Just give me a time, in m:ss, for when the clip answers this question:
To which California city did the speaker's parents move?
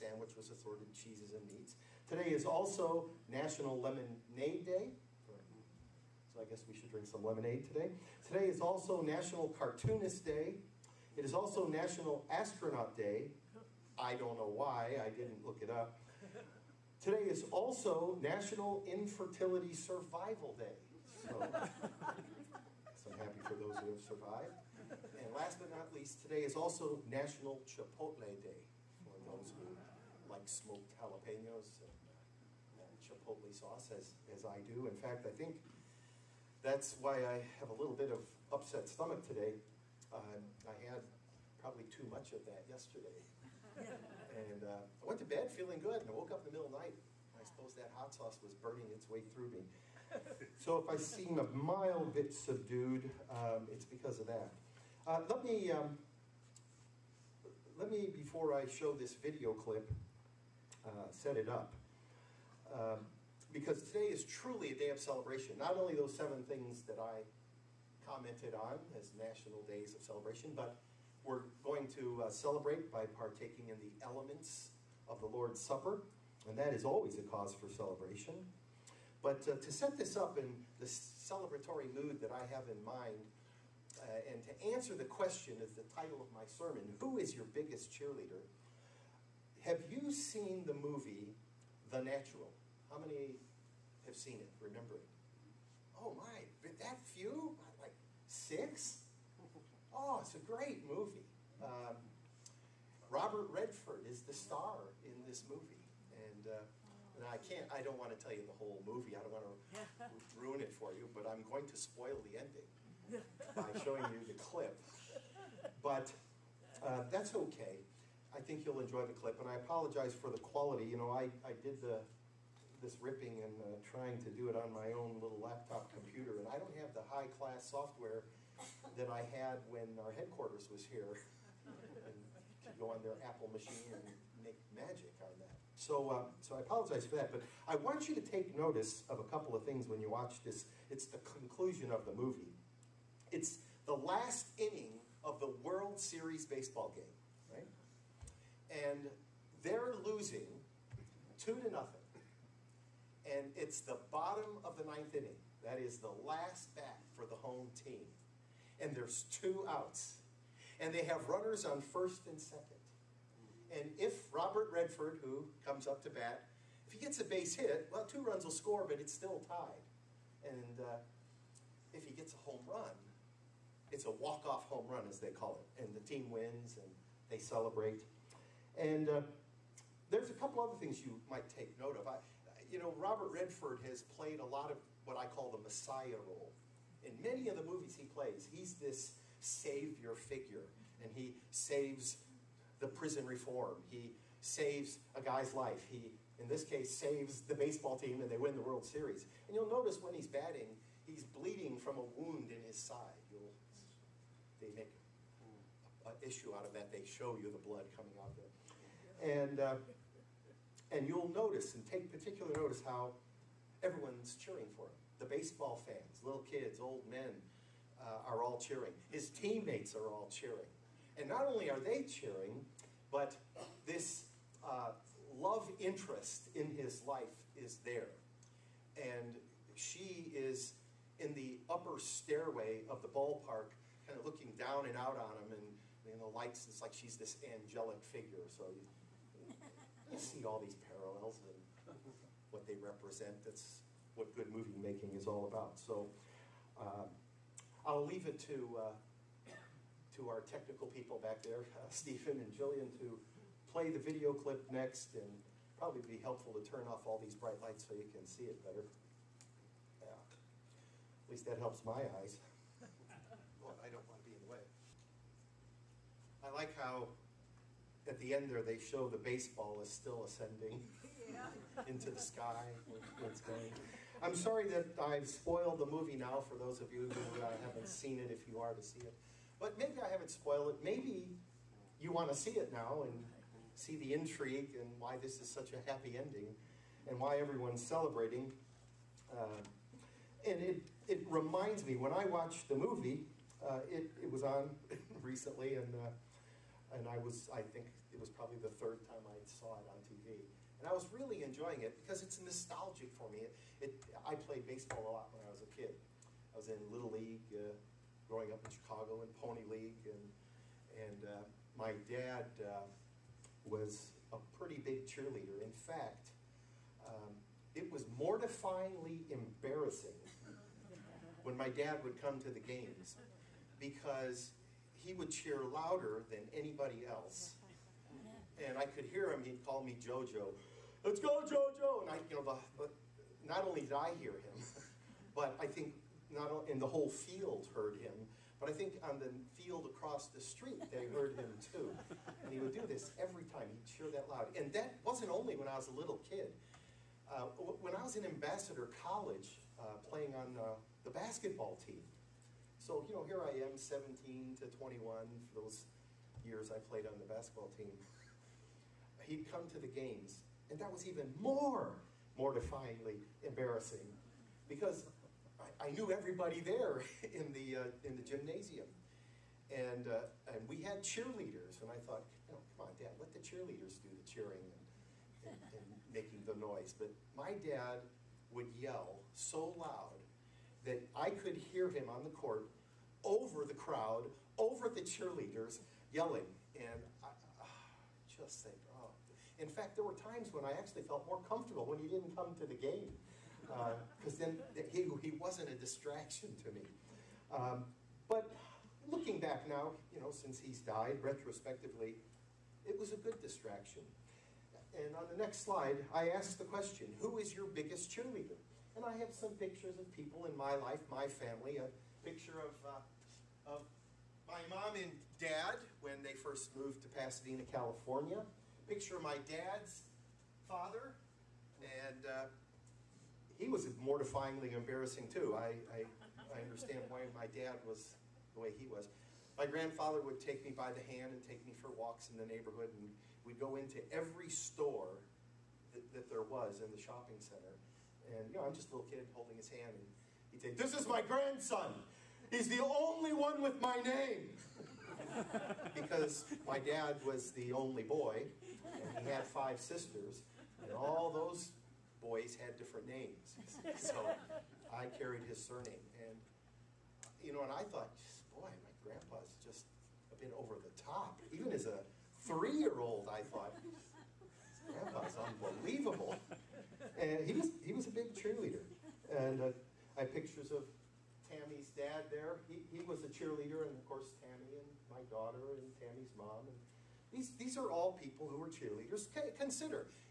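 6:57.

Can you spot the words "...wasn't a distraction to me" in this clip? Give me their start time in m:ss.
6:35.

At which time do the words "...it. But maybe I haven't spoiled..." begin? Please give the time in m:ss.
4:38.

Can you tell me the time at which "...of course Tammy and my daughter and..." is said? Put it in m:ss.
7:53.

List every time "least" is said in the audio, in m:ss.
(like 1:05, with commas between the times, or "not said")
0:25, 4:21.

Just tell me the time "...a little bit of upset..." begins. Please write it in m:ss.
0:37.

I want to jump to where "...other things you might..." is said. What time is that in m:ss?
3:00.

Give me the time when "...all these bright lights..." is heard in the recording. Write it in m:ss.
4:17.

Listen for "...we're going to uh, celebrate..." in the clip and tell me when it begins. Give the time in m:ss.
1:11.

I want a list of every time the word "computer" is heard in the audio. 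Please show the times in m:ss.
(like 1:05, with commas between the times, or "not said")
2:05.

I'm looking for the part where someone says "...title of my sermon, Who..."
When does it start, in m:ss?
1:25.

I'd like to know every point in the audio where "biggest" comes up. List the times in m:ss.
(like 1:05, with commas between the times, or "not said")
1:27, 6:47.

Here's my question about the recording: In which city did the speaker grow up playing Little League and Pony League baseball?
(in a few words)
Chicago.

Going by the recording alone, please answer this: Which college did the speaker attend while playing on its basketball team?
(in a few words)
Ambassador College.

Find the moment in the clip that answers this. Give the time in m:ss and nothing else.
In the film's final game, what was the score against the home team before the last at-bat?
2:31.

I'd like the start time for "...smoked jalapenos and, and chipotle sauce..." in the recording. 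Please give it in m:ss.
0:30.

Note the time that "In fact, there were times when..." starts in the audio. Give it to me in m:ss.
6:29.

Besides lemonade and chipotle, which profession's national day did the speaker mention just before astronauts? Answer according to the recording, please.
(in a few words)
Cartoonist.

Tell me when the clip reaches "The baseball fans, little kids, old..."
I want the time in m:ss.
3:35.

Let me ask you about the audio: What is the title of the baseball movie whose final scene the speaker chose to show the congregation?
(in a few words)
The Natural.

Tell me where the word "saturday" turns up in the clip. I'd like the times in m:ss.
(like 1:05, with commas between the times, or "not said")
not said.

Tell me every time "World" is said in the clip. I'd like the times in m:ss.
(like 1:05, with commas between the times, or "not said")
2:25, 3:18.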